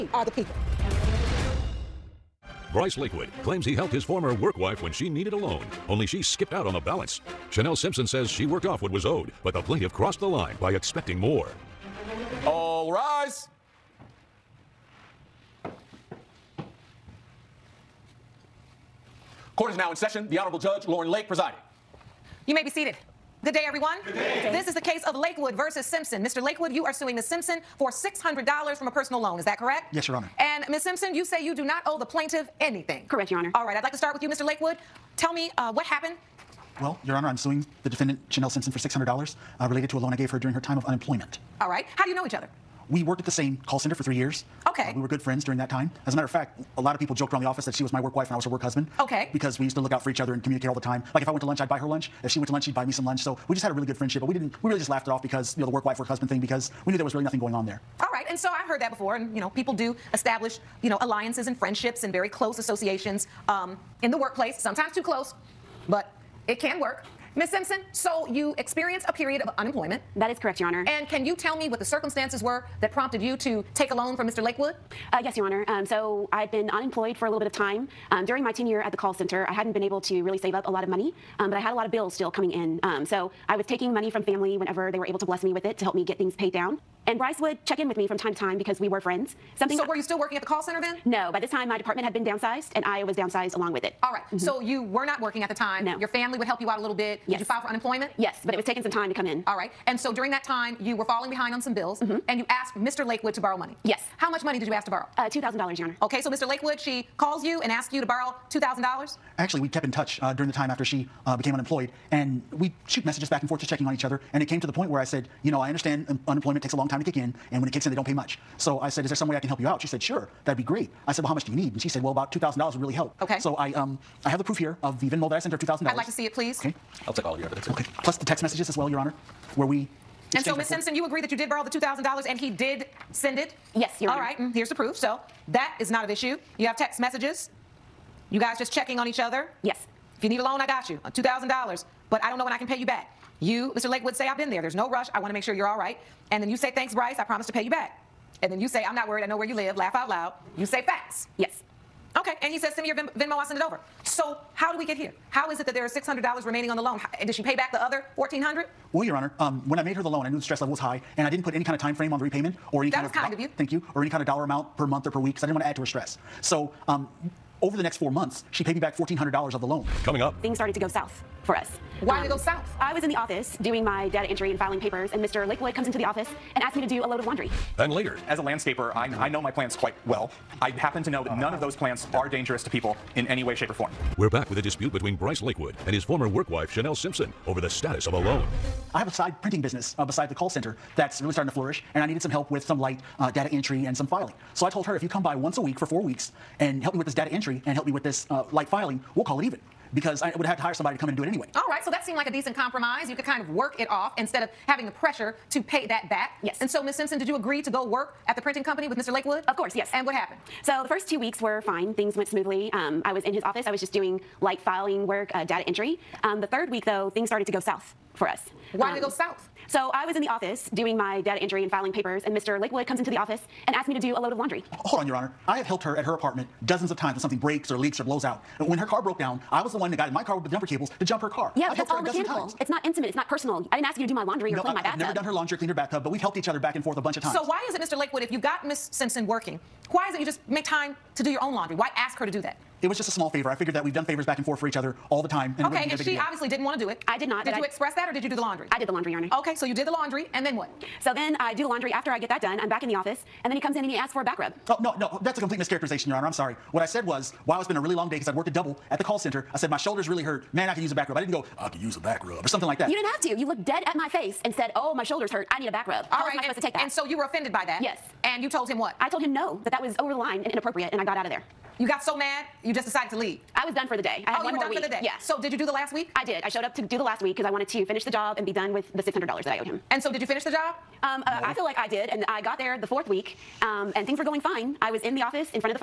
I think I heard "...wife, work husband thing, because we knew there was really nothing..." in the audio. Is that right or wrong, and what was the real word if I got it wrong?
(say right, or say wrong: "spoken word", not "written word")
right.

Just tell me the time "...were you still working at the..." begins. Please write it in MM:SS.
01:29.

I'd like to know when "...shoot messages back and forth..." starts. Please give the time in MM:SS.
01:52.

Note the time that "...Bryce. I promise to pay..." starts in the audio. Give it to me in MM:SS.
02:26.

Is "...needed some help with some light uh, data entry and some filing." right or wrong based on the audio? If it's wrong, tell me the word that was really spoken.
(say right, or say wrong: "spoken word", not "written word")
right.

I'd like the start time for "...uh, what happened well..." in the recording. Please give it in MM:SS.
00:35.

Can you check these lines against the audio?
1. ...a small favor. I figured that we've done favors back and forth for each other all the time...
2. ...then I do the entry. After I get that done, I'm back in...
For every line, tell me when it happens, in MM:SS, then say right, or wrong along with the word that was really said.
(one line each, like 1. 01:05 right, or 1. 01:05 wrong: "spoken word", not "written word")
1. 04:03 right
2. 04:11 wrong: "laundry", not "entry".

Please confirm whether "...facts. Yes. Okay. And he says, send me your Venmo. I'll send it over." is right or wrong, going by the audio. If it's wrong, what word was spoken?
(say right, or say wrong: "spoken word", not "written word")
right.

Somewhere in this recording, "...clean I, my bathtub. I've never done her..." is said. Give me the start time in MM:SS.
03:54.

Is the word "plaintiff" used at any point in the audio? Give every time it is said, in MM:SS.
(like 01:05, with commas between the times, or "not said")
00:09, 00:32.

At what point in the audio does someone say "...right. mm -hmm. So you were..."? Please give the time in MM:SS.
01:34.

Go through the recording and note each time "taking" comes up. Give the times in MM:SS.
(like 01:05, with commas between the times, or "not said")
01:23, 01:38.